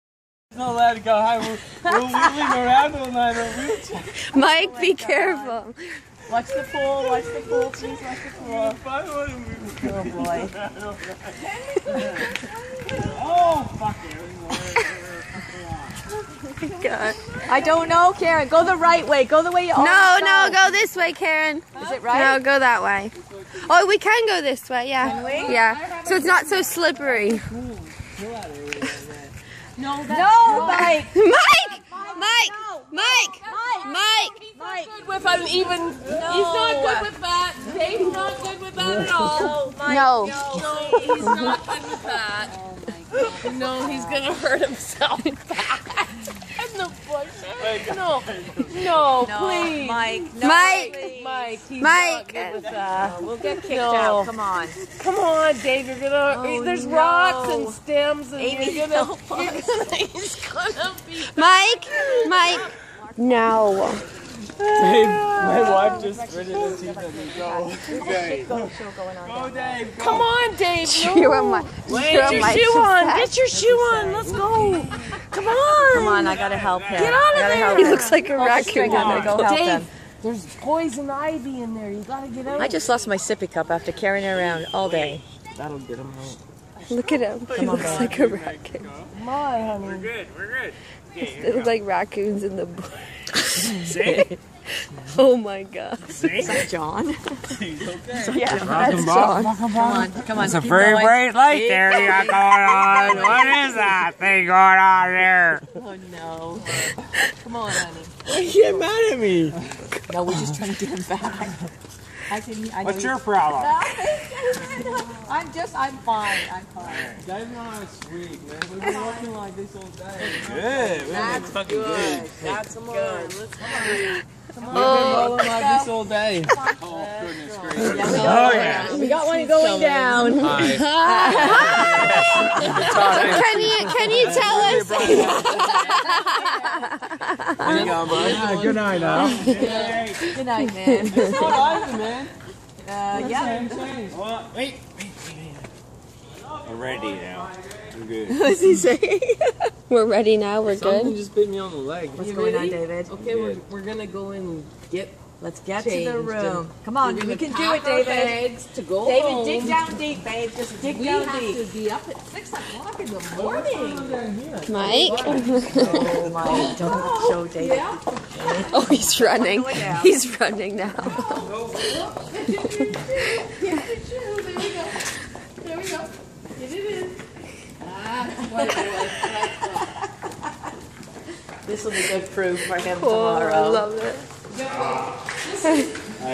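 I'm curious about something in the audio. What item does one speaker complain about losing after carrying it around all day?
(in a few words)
sippy cup.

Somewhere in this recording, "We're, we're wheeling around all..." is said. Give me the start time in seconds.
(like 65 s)
1 s.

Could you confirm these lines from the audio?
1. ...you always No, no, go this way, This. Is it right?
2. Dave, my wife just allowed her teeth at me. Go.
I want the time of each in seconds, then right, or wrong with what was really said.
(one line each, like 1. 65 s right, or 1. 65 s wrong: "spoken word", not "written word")
1. 19 s wrong: "Karen", not "This"
2. 64 s wrong: "gritted", not "allowed".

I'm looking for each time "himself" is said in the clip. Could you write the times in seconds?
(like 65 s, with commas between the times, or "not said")
44 s.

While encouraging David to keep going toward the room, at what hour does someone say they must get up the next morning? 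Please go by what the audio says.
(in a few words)
6 o'clock.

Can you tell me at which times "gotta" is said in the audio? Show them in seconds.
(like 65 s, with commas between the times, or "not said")
76 s, 82 s.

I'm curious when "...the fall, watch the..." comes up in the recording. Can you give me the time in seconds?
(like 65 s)
6 s.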